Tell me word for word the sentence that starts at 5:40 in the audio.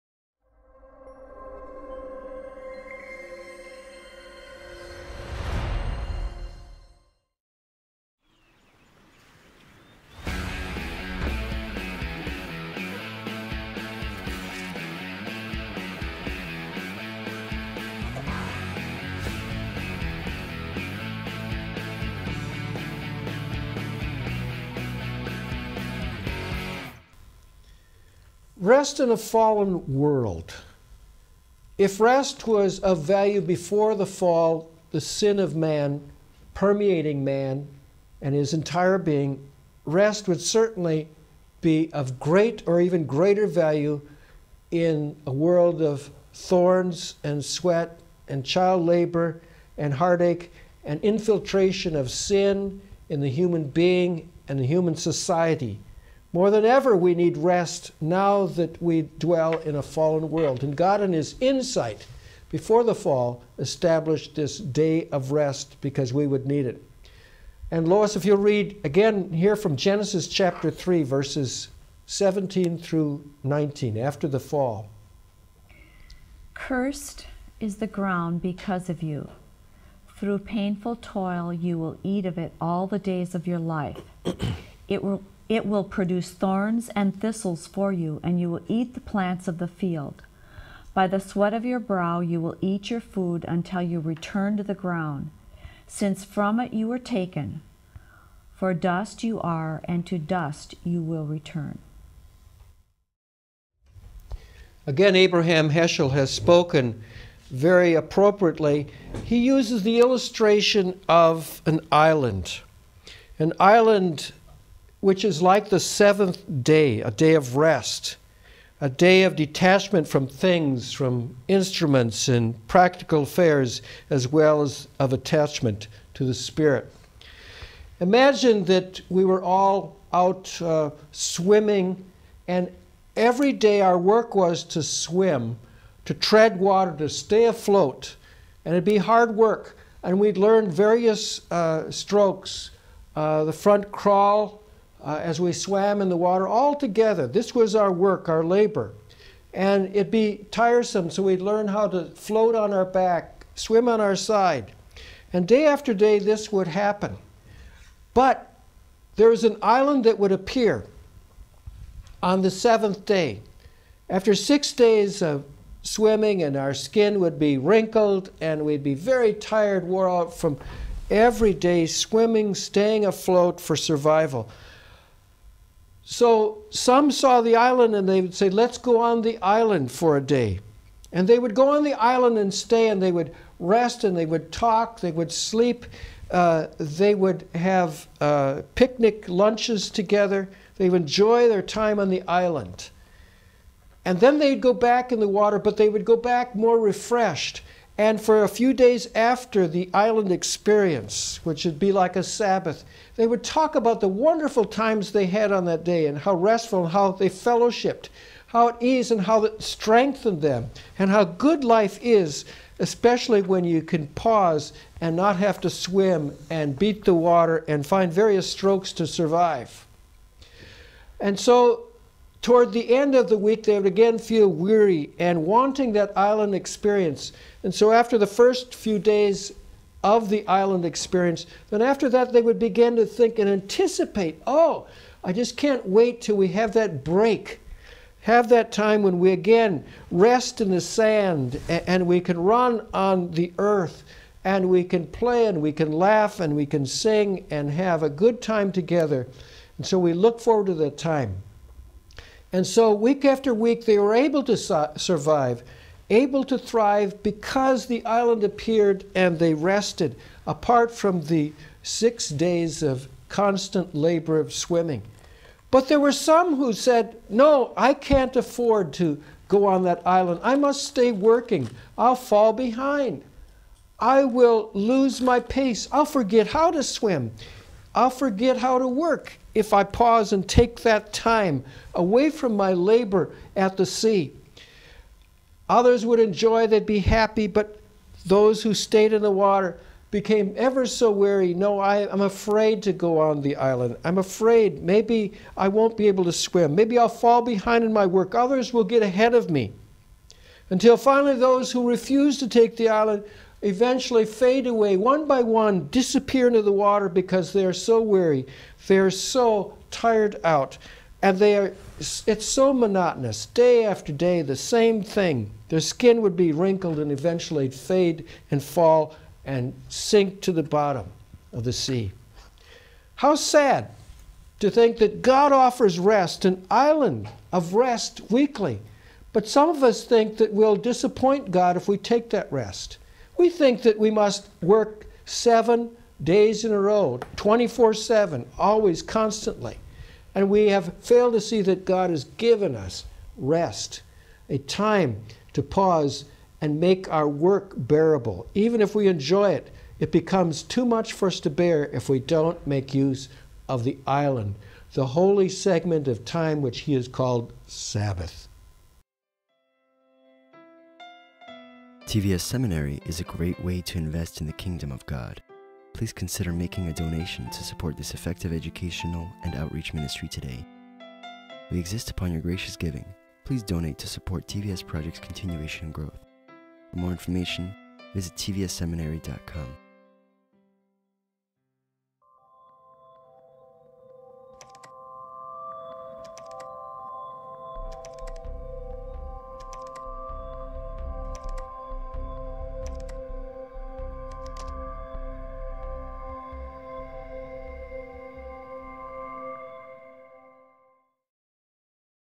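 And we have failed to see that God has given us rest, a time to pause and make our work bearable.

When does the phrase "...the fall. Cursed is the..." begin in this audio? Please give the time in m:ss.
1:14.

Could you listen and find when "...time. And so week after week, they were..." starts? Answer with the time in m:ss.
4:10.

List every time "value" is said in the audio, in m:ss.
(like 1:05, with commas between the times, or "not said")
0:33, 0:43.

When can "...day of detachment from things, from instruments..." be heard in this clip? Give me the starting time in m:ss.
1:58.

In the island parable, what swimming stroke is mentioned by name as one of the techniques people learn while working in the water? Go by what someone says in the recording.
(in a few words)
front crawl.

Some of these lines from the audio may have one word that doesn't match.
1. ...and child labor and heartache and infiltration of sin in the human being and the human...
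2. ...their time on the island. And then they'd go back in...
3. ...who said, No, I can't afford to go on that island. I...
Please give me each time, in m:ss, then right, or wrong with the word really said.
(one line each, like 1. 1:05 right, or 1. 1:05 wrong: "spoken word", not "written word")
1. 0:48 right
2. 3:11 right
3. 4:26 right.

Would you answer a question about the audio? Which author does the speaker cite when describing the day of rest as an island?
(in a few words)
Abraham Heschel.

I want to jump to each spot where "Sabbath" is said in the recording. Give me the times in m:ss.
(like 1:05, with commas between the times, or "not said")
3:22, 5:57.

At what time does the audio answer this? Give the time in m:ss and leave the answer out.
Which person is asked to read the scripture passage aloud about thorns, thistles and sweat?
1:07.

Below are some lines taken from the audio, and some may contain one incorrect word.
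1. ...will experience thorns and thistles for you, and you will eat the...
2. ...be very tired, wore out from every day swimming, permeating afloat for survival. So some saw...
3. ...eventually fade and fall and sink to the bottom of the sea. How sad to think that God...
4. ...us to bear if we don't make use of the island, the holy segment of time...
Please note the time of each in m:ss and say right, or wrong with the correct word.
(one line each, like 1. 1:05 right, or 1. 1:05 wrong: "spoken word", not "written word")
1. 1:25 wrong: "produce", not "experience"
2. 2:48 wrong: "staying", not "permeating"
3. 5:17 right
4. 5:51 right.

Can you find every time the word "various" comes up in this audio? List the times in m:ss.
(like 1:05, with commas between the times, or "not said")
2:20, 3:38.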